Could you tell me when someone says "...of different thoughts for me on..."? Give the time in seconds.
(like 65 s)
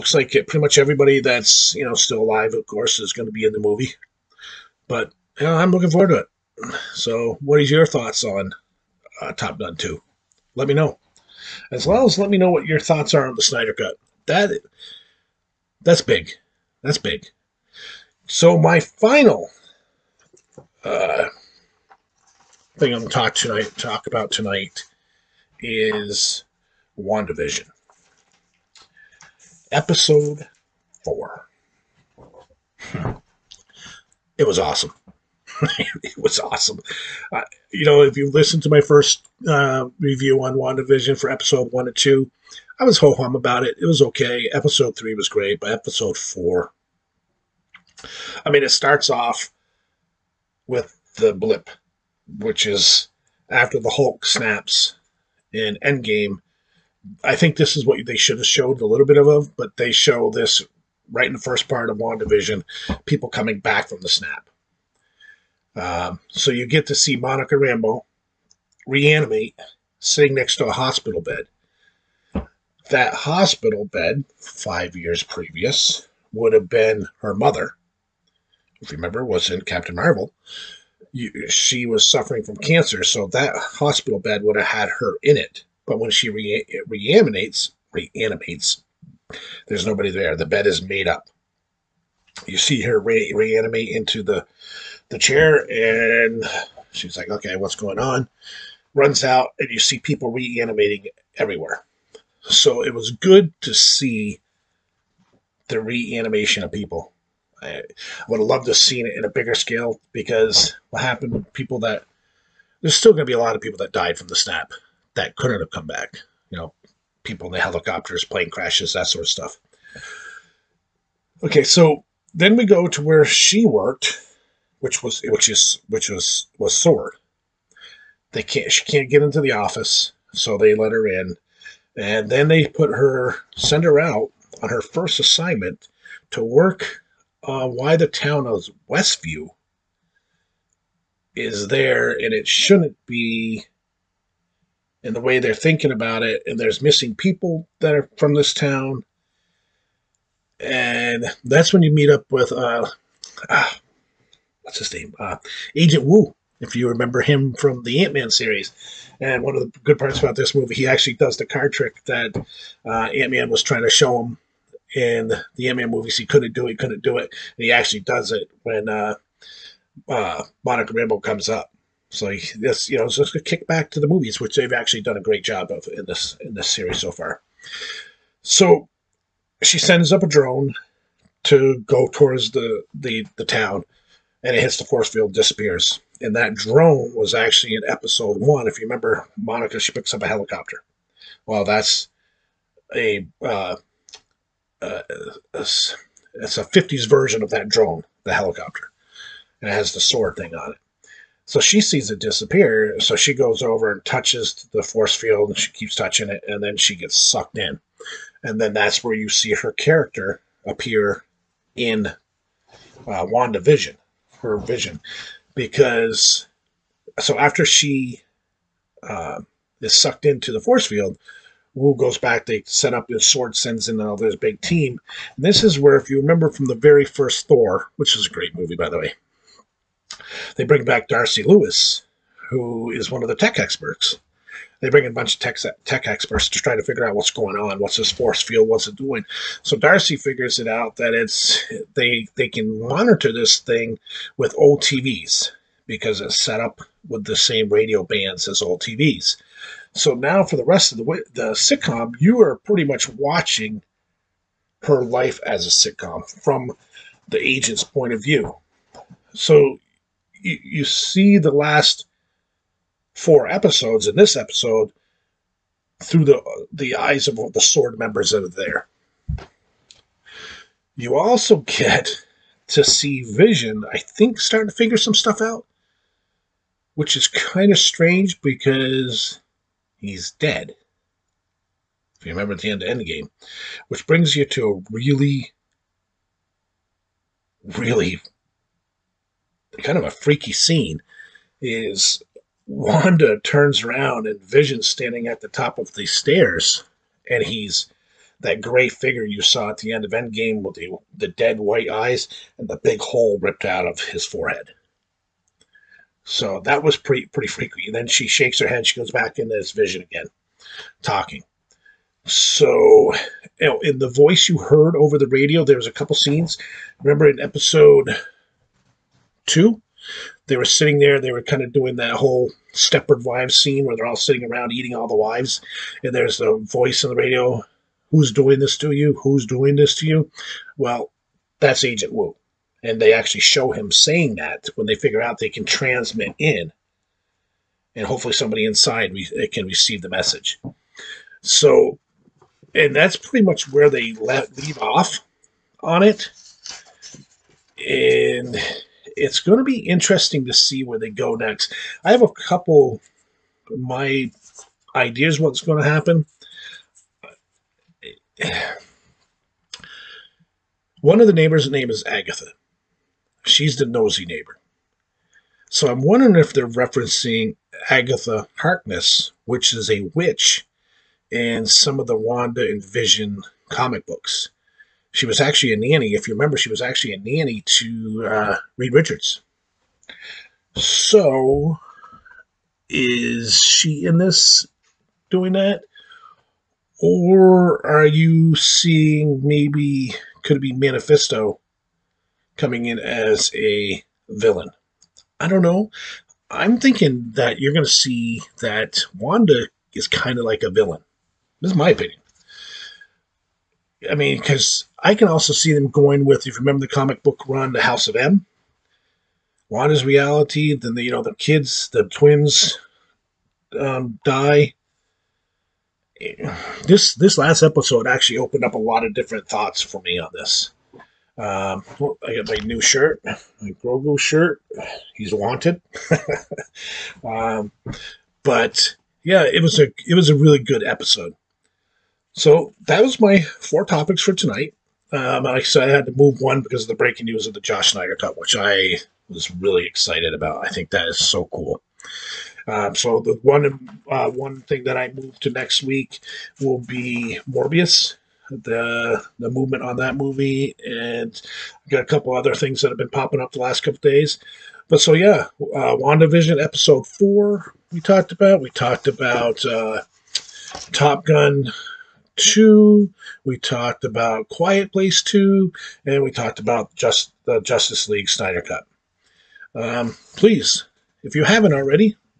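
419 s.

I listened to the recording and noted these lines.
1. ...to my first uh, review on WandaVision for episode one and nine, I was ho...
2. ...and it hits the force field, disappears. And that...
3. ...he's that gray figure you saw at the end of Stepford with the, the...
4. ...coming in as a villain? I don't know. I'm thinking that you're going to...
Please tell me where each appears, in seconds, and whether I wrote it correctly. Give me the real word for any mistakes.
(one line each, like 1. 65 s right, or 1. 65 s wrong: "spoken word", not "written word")
1. 38 s wrong: "two", not "nine"
2. 184 s right
3. 297 s wrong: "Endgame", not "Stepford"
4. 392 s right.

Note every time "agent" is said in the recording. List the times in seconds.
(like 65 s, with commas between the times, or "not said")
155 s, 257 s, 331 s.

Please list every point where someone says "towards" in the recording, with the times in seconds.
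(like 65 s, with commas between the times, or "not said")
182 s.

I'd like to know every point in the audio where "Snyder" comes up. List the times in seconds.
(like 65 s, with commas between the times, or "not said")
13 s, 437 s, 468 s.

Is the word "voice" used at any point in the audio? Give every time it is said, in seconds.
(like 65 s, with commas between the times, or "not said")
314 s, 326 s.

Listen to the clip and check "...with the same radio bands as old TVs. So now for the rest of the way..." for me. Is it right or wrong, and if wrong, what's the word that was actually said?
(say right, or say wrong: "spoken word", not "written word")
right.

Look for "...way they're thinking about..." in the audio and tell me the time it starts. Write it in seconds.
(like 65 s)
145 s.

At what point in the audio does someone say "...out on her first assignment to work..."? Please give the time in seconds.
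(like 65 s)
134 s.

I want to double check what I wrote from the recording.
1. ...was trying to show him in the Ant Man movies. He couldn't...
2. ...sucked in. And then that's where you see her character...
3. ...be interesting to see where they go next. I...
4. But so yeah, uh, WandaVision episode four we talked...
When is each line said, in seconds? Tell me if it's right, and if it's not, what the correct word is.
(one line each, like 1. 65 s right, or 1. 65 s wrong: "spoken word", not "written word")
1. 163 s right
2. 207 s right
3. 349 s right
4. 454 s right.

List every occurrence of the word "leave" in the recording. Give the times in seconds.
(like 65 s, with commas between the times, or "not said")
344 s.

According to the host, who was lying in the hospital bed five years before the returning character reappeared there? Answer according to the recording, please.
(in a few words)
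Her mother.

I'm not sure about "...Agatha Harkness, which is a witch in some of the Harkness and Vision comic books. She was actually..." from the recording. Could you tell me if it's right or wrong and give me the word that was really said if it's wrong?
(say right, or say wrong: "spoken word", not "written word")
wrong: "Wanda", not "Harkness".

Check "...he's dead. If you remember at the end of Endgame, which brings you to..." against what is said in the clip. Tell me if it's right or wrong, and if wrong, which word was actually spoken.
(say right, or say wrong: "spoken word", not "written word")
right.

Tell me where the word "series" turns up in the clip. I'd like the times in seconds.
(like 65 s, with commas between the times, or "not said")
158 s, 176 s.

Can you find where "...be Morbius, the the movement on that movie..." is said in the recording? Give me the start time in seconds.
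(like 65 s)
446 s.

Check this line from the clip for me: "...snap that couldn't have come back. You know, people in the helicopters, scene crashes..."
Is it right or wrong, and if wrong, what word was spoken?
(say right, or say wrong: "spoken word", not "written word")
wrong: "plane", not "scene".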